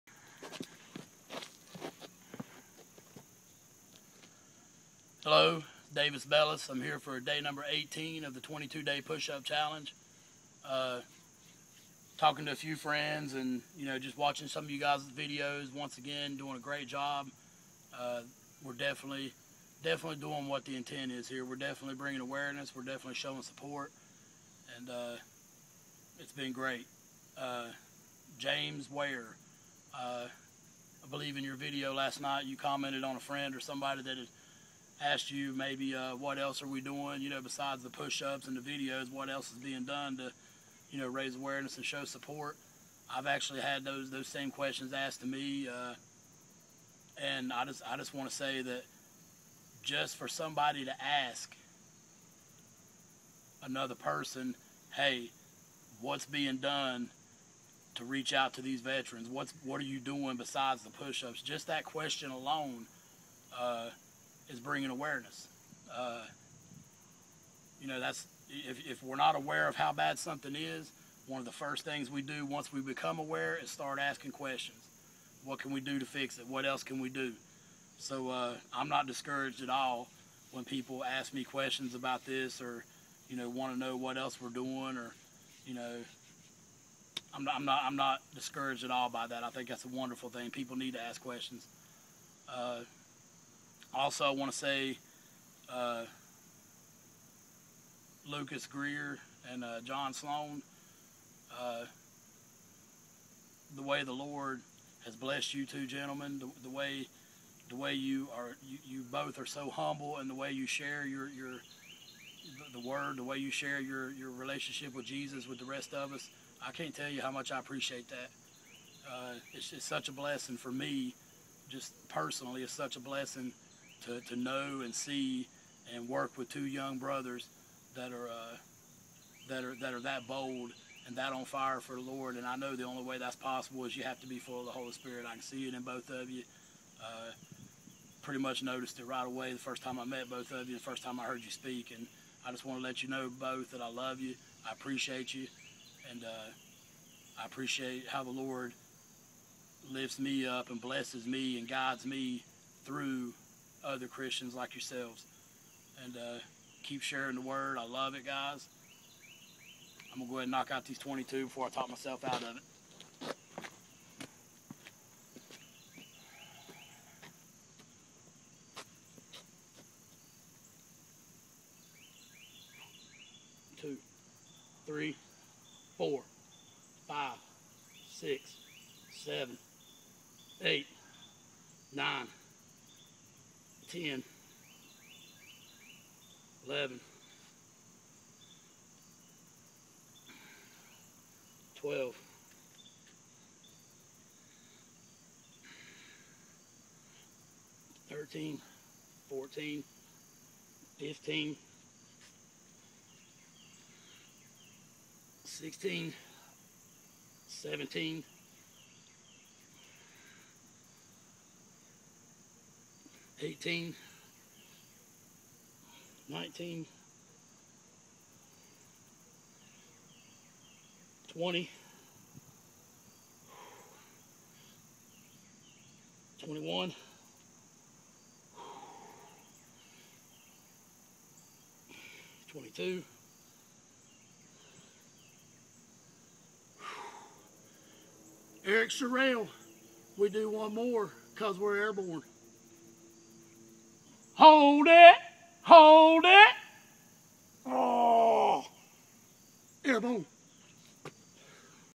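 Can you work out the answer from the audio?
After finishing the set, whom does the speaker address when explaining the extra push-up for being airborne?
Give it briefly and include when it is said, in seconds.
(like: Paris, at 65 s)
Eric Sorrell, at 238 s.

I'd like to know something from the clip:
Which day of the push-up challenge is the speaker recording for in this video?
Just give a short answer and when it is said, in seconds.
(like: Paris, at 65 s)
18, at 7 s.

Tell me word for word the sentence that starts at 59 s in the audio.
What's what are you doing besides the push-ups?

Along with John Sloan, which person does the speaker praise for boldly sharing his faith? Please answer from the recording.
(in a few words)
Lucas Greer.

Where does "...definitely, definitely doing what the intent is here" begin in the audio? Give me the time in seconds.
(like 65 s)
18 s.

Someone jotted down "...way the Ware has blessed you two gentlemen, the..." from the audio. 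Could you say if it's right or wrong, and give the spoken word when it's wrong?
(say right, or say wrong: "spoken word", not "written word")
wrong: "Lord", not "Ware".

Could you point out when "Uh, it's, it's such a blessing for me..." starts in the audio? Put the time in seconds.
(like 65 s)
119 s.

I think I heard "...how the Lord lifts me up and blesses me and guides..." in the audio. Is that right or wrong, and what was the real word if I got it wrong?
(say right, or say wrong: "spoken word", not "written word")
right.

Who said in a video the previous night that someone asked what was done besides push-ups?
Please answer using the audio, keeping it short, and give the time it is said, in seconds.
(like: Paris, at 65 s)
James Ware, at 28 s.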